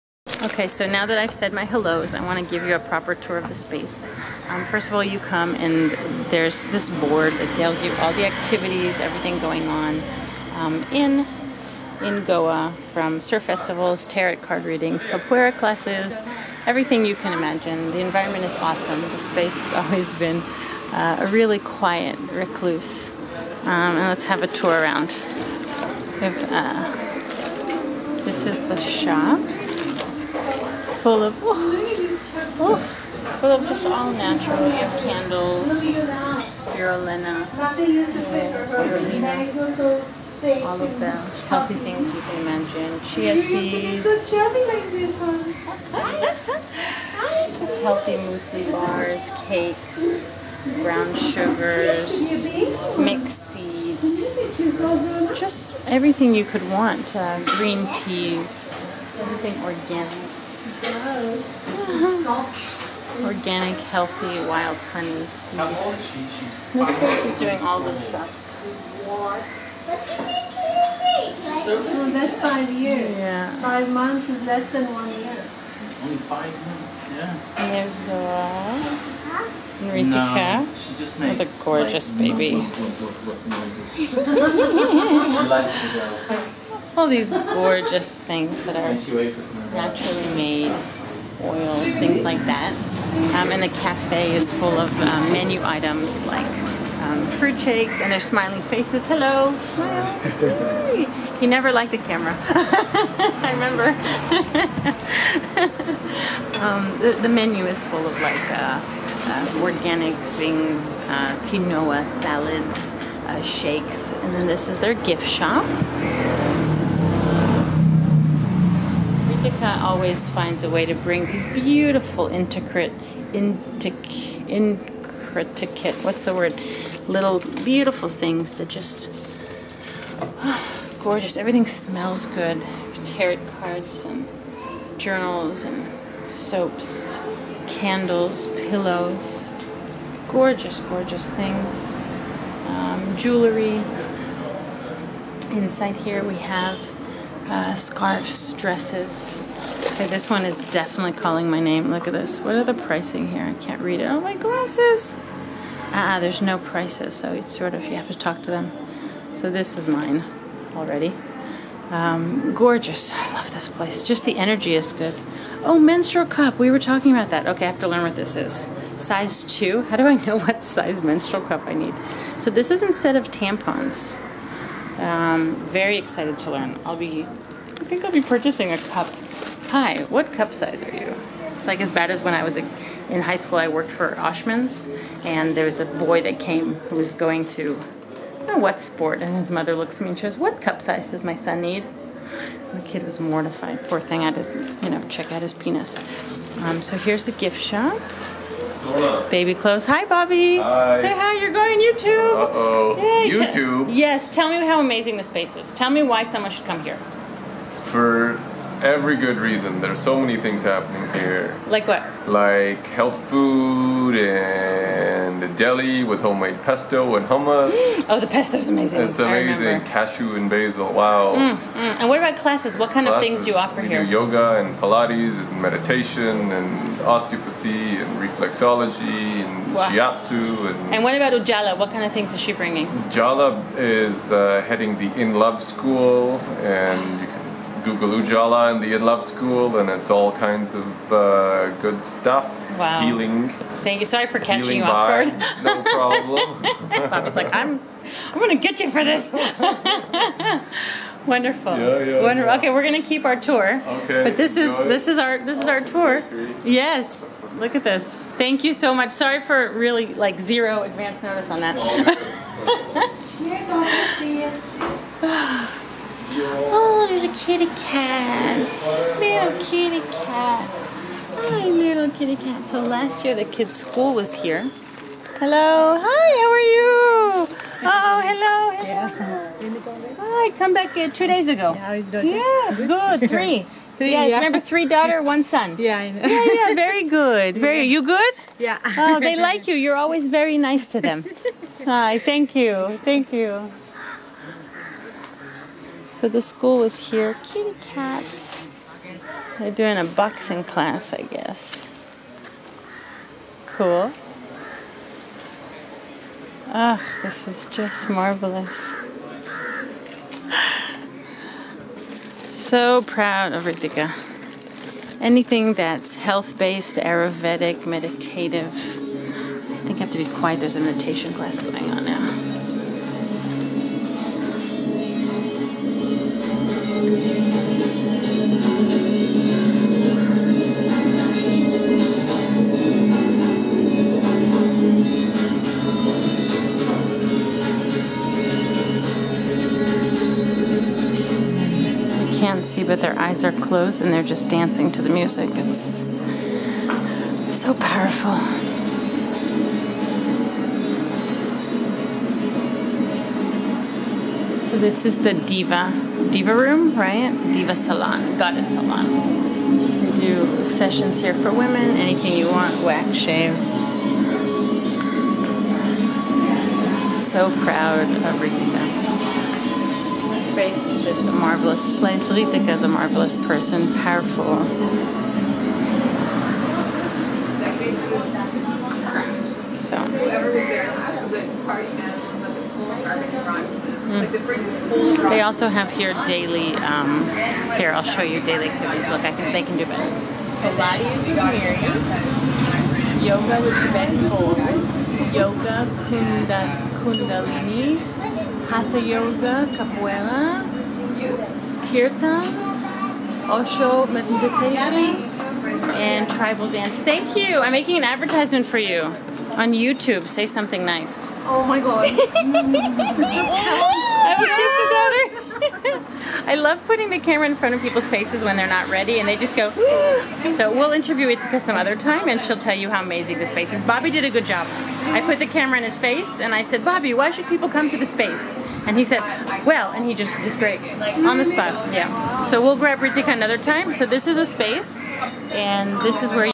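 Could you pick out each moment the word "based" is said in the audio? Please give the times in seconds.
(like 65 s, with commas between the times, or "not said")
316 s.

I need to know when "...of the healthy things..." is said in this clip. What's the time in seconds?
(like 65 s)
40 s.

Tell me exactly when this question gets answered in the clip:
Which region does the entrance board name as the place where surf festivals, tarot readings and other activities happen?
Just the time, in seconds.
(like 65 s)
12 s.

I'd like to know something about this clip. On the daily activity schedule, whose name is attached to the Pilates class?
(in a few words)
Miriam.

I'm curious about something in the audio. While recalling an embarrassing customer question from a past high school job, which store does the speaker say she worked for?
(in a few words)
Oshman's.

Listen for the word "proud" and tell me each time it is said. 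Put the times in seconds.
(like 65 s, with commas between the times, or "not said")
313 s, 367 s.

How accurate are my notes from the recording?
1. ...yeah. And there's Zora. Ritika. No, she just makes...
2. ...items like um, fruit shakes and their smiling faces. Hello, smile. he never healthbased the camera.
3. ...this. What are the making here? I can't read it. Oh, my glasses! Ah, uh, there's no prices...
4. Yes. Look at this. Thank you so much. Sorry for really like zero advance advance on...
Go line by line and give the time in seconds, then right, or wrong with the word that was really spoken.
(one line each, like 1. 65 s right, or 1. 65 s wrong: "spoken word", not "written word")
1. 77 s right
2. 95 s wrong: "liked", not "healthbased"
3. 152 s wrong: "pricing", not "making"
4. 256 s wrong: "notice", not "advance".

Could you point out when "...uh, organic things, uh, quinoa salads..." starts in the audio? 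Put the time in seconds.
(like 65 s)
108 s.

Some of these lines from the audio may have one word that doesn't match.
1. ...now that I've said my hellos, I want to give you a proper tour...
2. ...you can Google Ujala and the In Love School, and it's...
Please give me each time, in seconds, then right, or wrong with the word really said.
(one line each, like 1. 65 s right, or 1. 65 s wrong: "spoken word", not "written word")
1. 0 s right
2. 237 s right.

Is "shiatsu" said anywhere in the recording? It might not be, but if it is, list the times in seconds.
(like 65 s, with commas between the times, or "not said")
229 s.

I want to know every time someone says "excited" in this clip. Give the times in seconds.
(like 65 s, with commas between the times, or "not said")
175 s.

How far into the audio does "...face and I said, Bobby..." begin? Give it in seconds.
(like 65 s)
425 s.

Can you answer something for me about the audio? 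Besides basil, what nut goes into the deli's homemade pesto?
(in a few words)
Cashew.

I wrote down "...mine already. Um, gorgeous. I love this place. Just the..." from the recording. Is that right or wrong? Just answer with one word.
right.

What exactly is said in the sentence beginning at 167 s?
Okay, I have to learn what this is.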